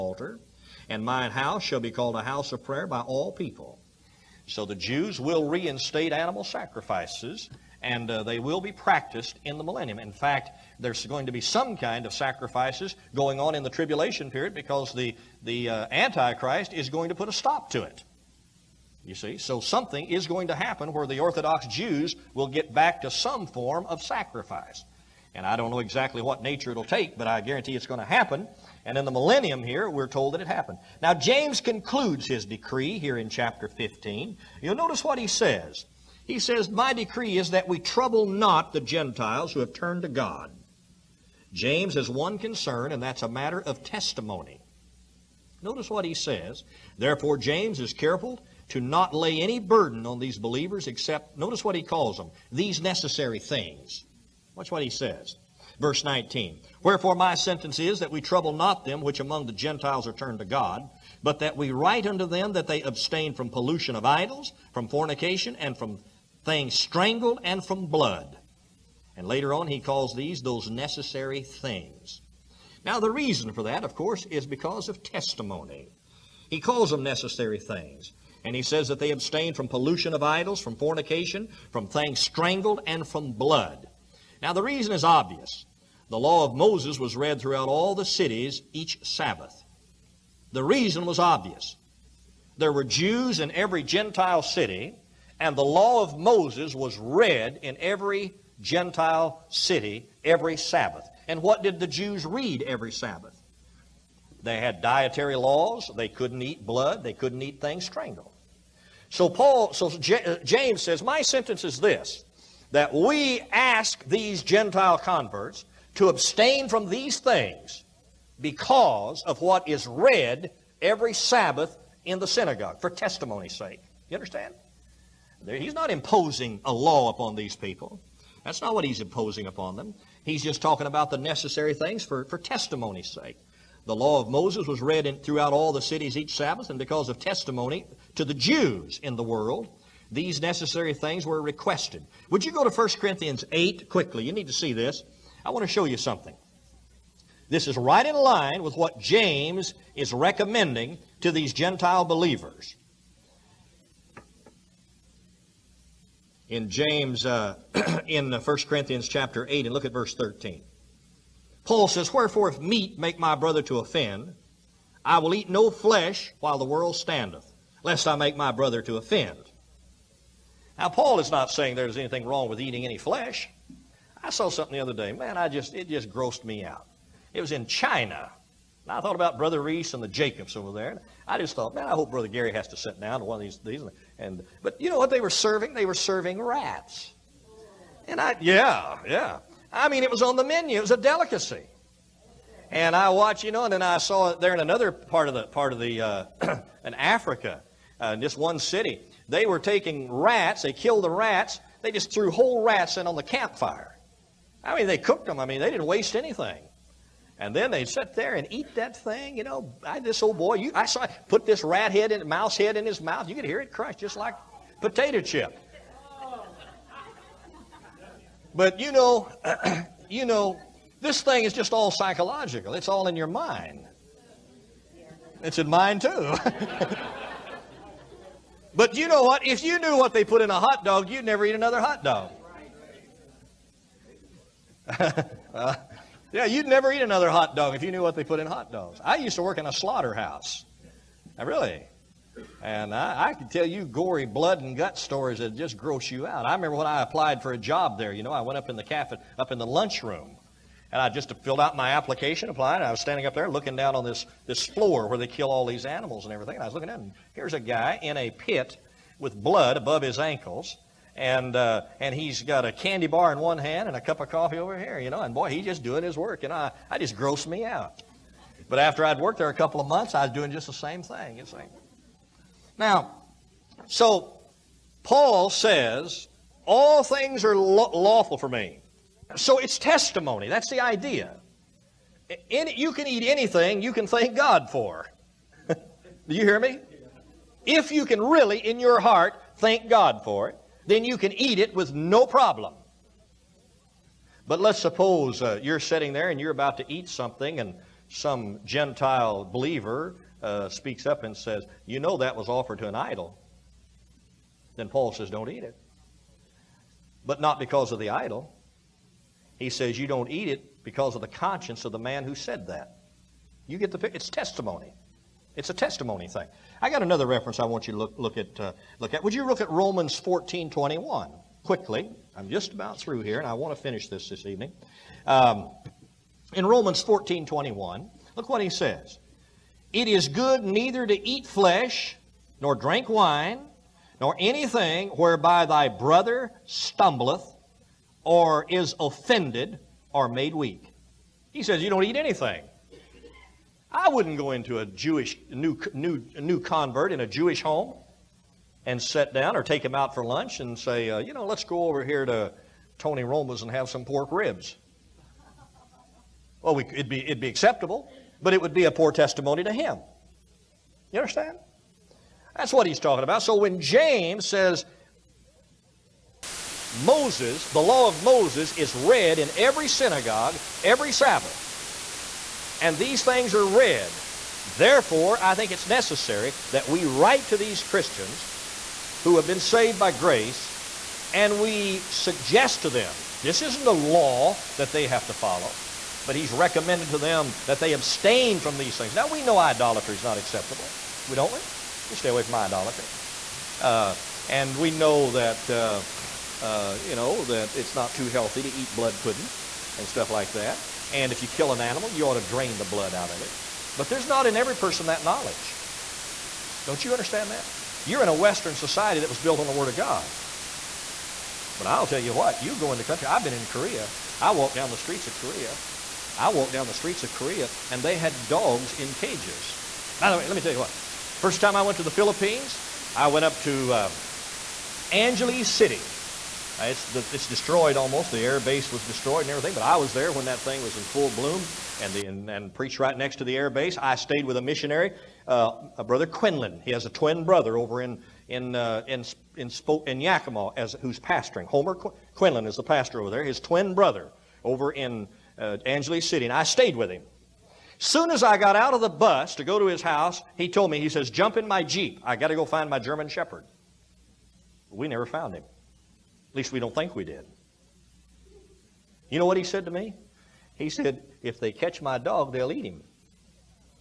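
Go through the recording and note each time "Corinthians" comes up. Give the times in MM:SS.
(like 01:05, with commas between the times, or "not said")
02:22, 02:38.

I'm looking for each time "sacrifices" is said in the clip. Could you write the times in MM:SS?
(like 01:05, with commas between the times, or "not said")
00:06, 00:12, 00:24.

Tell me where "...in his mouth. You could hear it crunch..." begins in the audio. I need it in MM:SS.
03:32.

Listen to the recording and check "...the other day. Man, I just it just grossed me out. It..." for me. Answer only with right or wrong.
right.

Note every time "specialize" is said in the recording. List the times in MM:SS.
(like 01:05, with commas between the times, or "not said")
not said.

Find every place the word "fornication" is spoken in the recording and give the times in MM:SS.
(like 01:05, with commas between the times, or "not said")
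01:04, 01:20.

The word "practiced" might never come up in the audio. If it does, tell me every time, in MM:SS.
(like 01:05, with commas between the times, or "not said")
00:08.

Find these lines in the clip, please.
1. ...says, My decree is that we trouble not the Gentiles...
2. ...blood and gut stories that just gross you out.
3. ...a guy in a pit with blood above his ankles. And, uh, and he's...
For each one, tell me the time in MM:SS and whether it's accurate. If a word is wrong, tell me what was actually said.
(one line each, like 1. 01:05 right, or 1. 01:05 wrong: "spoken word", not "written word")
1. 00:36 right
2. 04:04 right
3. 04:17 right.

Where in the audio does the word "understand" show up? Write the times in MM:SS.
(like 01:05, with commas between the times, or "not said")
02:04, 06:01, 06:47.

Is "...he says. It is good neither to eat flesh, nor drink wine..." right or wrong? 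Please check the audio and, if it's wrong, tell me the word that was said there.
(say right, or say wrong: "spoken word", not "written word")
right.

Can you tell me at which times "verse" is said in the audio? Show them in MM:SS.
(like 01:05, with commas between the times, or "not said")
00:55, 02:39.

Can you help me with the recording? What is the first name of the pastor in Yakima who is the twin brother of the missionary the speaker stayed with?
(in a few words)
Homer.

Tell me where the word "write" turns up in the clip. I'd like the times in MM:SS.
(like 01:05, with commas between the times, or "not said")
01:01, 06:17.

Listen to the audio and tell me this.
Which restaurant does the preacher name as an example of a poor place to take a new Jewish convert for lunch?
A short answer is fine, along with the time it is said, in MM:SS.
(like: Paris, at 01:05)
Tony Roma's, at 05:52.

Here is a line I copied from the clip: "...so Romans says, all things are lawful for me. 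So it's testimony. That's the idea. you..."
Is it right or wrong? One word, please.
wrong.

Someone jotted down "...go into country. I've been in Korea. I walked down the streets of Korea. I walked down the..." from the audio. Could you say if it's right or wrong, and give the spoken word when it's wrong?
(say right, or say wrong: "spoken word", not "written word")
right.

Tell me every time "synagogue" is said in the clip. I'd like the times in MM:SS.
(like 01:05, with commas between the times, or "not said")
02:02, 06:09.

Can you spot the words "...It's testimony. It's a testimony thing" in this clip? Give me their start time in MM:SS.
05:14.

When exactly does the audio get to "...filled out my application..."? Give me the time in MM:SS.
04:11.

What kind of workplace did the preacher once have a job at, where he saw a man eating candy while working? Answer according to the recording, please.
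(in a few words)
A slaughterhouse.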